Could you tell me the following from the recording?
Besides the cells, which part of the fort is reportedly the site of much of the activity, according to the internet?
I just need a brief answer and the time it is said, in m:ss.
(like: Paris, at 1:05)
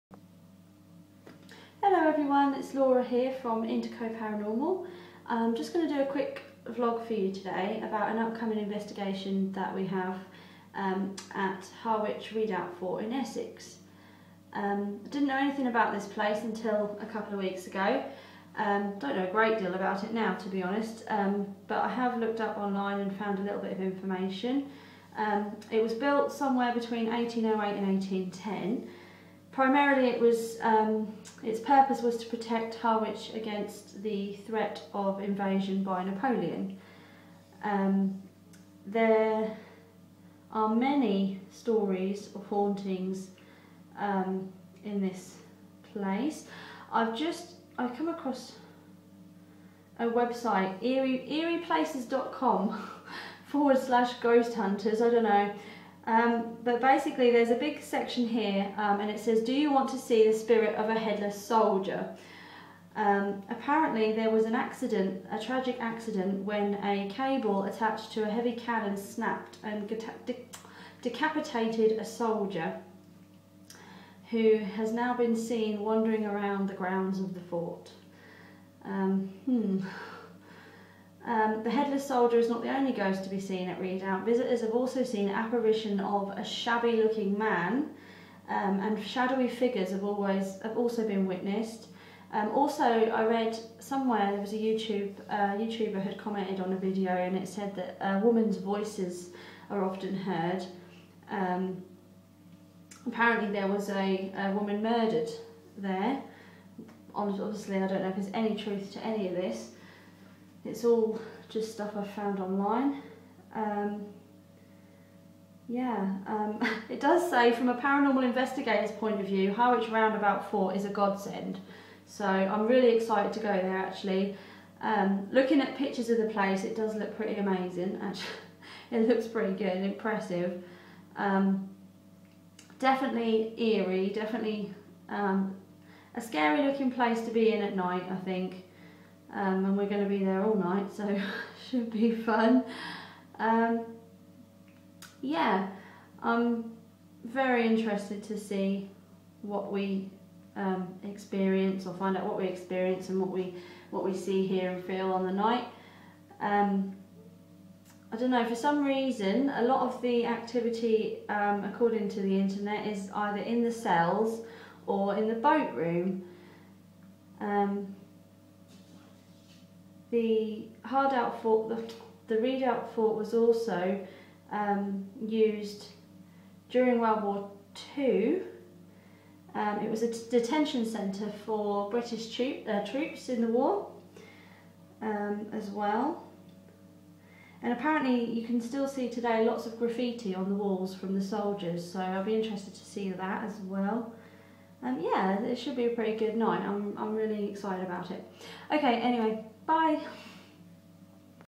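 The boat room, at 2:45.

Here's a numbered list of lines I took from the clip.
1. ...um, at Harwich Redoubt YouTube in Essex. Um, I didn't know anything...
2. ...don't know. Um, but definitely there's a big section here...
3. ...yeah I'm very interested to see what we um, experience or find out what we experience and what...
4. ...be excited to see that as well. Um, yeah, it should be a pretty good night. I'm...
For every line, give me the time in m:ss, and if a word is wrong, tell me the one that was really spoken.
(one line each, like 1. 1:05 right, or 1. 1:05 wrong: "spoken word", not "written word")
1. 0:10 wrong: "Fort", not "YouTube"
2. 0:55 wrong: "basically", not "definitely"
3. 2:25 right
4. 3:12 wrong: "interested", not "excited".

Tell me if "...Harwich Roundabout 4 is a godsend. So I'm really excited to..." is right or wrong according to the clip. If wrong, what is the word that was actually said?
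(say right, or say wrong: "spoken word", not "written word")
right.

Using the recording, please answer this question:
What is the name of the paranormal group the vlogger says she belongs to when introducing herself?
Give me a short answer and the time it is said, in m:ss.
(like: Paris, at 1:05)
Indico Paranormal, at 0:03.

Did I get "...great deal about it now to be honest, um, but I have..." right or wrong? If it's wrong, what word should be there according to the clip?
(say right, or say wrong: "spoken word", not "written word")
right.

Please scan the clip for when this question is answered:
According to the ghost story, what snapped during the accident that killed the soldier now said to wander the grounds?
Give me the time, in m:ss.
1:06.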